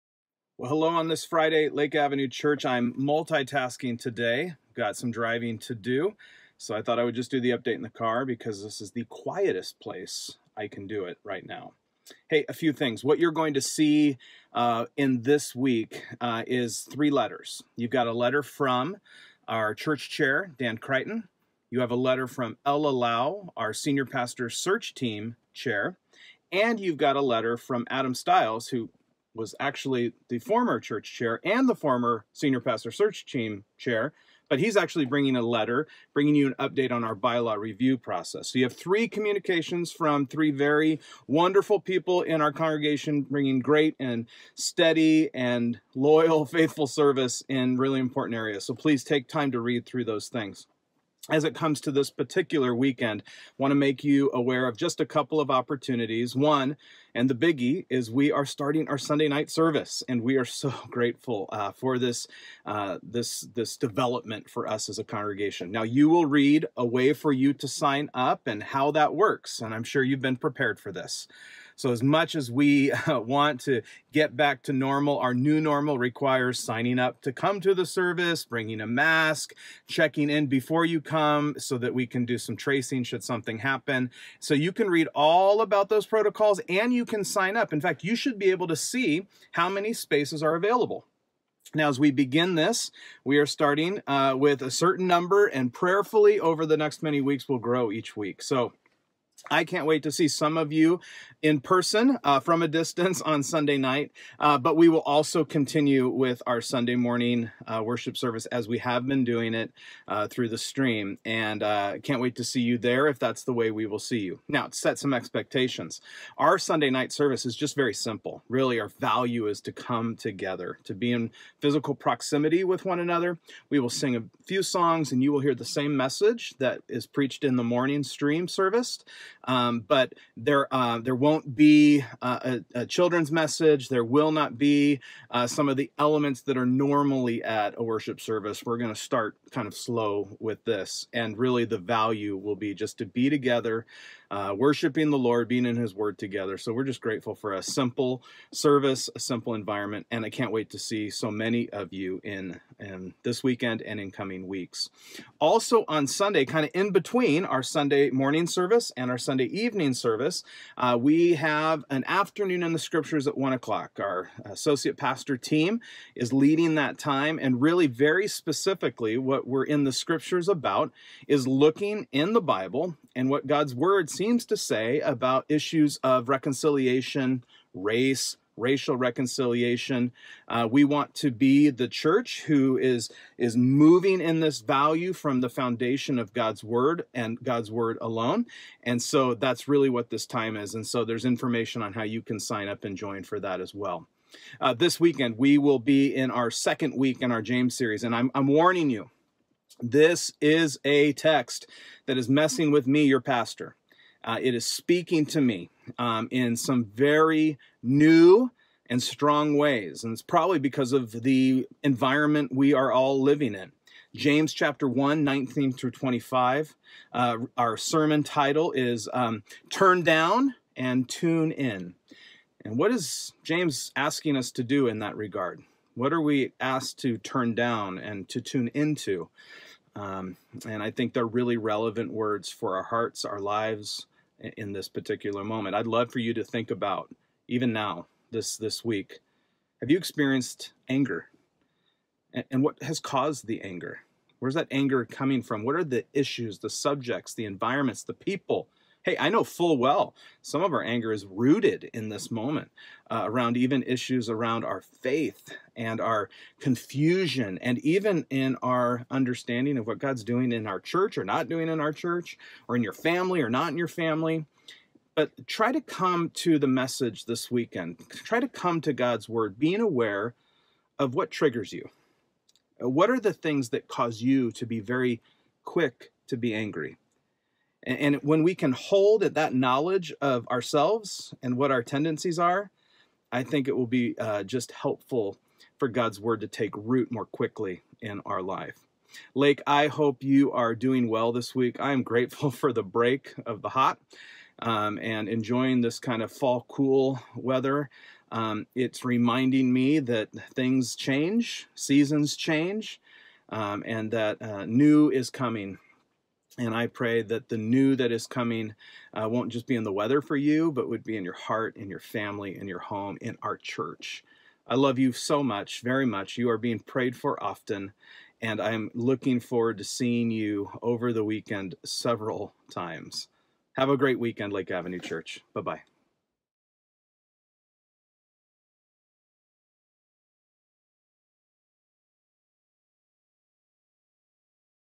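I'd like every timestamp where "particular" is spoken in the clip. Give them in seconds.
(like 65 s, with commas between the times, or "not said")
52 s, 234 s.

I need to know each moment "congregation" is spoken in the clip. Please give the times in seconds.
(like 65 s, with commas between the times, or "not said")
42 s, 65 s.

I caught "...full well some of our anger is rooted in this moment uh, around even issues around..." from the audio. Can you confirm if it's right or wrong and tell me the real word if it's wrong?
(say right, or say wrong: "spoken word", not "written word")
right.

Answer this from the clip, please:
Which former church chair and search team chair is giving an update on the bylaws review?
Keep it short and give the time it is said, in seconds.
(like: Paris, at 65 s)
Adam Stiles, at 27 s.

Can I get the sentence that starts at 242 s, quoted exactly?
And, and what has caused the anger?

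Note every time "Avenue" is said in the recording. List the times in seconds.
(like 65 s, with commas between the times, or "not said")
1 s, 324 s.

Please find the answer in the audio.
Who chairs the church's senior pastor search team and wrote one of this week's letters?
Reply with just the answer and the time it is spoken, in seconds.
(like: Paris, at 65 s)
Ella Lau, at 22 s.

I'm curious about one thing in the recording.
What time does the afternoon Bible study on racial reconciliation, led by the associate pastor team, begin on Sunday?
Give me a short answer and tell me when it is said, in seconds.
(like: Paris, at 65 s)
1:00, at 163 s.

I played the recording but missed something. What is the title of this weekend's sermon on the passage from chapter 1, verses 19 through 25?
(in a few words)
Turn Down and Tune In.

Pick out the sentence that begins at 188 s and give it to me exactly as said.
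And so that's really what this time is.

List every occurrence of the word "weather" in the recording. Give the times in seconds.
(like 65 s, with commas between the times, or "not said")
297 s, 309 s.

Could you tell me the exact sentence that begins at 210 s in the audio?
And it's probably because of the environment we are all living in.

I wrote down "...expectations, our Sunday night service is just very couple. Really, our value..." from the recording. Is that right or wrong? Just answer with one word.
wrong.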